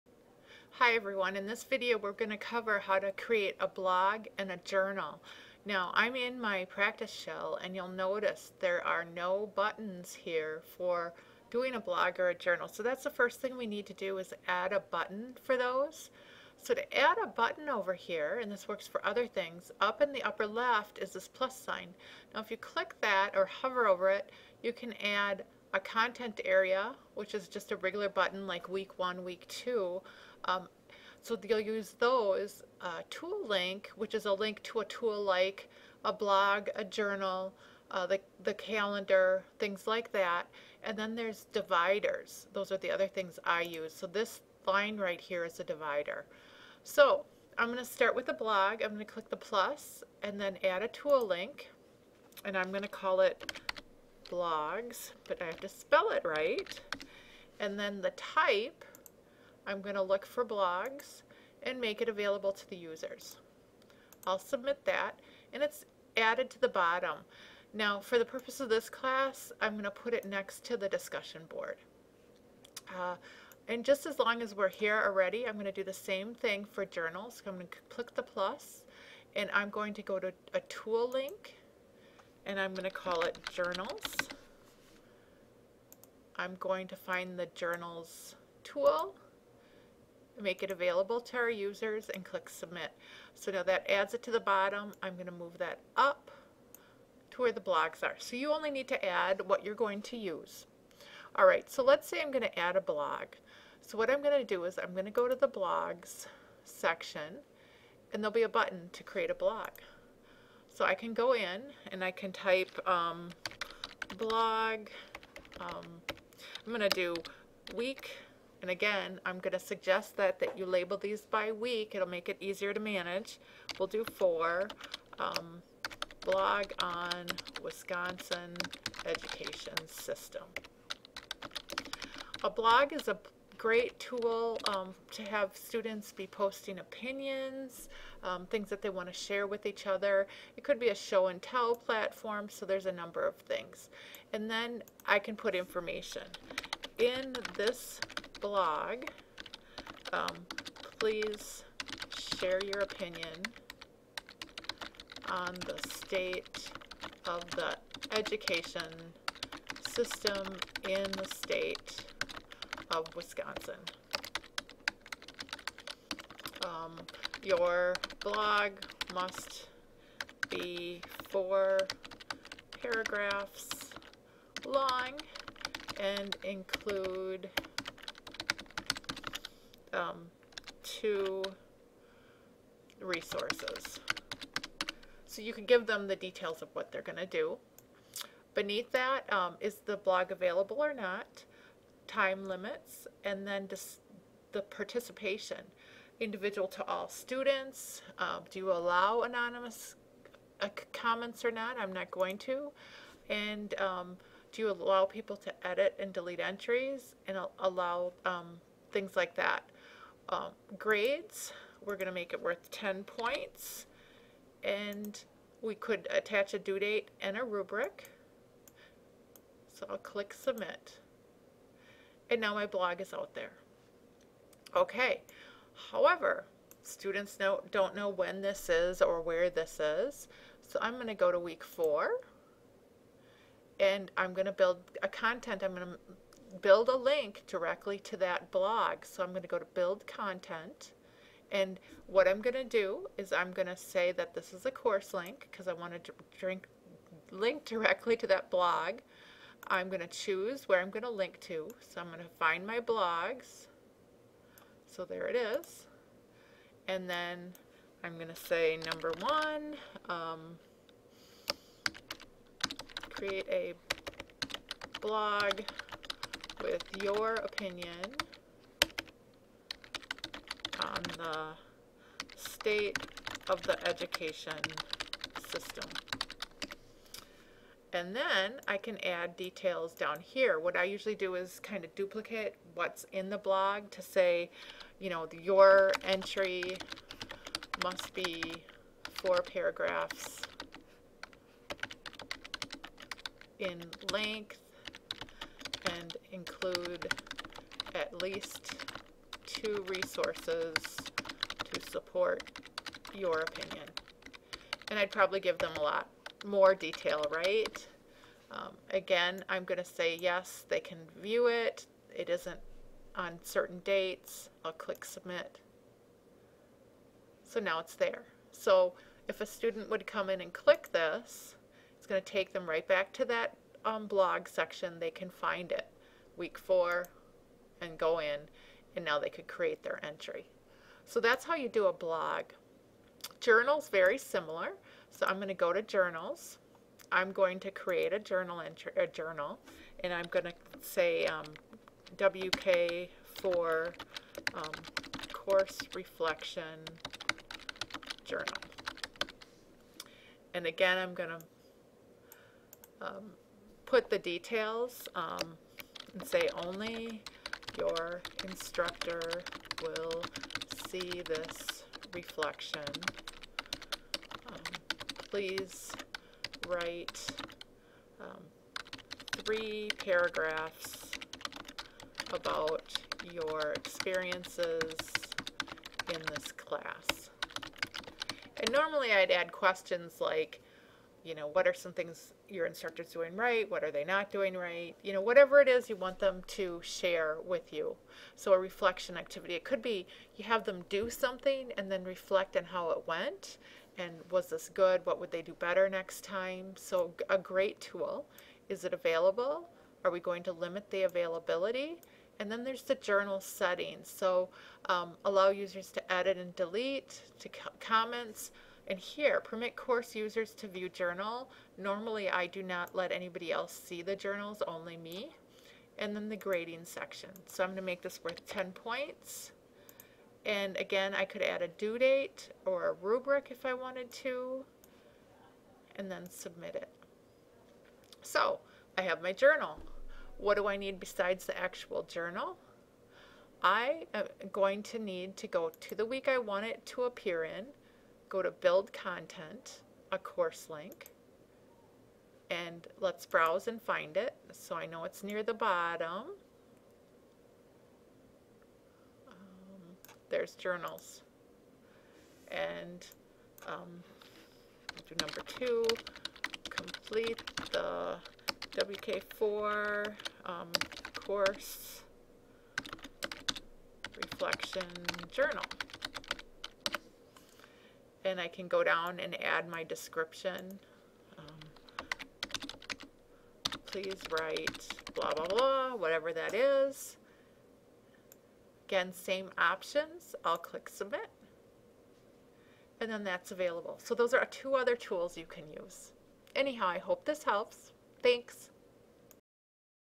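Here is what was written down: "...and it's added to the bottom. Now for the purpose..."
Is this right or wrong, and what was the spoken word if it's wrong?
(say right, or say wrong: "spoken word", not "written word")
right.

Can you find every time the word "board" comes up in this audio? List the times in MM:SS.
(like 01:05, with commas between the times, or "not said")
01:11.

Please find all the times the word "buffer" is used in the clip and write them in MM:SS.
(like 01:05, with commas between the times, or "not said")
not said.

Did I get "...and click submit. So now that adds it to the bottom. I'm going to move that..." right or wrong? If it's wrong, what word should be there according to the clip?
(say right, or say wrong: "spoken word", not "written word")
right.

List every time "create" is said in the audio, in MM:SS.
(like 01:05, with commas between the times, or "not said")
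00:03, 01:49, 04:23, 05:29, 05:37.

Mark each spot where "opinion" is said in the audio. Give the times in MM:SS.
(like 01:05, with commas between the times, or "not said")
02:16, 02:32, 04:27, 05:03.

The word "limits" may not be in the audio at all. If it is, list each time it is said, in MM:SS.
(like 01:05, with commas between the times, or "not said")
03:12, 06:40.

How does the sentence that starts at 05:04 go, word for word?
And I'd probably give them a lot more detail, right?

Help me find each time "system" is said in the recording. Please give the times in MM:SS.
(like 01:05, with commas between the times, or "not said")
02:09, 02:39, 04:35.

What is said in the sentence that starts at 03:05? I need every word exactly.
So you can give them the details of what they're going to do.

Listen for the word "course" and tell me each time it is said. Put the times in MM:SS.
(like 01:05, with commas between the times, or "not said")
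04:04, 05:45, 06:49, 07:20, 07:41.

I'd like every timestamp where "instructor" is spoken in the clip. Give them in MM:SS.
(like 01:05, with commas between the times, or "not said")
05:58, 06:22.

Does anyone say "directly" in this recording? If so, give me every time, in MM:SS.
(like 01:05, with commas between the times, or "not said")
03:57, 04:07.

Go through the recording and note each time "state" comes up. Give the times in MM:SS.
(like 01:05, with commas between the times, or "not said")
02:35, 02:41, 04:32.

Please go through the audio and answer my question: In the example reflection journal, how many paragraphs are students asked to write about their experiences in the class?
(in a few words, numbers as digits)
3.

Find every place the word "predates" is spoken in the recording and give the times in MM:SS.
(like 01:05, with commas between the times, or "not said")
not said.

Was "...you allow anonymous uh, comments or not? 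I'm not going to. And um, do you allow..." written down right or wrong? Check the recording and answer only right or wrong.
right.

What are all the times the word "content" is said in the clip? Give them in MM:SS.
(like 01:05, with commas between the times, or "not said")
00:25, 03:55, 04:00, 07:18.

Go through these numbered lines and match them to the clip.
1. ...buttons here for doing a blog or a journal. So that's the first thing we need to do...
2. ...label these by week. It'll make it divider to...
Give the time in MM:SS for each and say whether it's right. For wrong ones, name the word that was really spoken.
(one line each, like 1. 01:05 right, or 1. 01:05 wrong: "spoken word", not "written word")
1. 00:09 right
2. 02:00 wrong: "easier", not "divider".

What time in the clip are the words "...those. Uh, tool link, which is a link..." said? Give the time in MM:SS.
00:31.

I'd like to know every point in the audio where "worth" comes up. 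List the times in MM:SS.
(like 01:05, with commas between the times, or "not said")
03:32, 06:58.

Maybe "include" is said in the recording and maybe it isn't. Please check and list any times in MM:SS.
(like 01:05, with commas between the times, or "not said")
02:56, 04:56.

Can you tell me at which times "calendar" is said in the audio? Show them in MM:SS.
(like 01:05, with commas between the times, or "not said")
00:38.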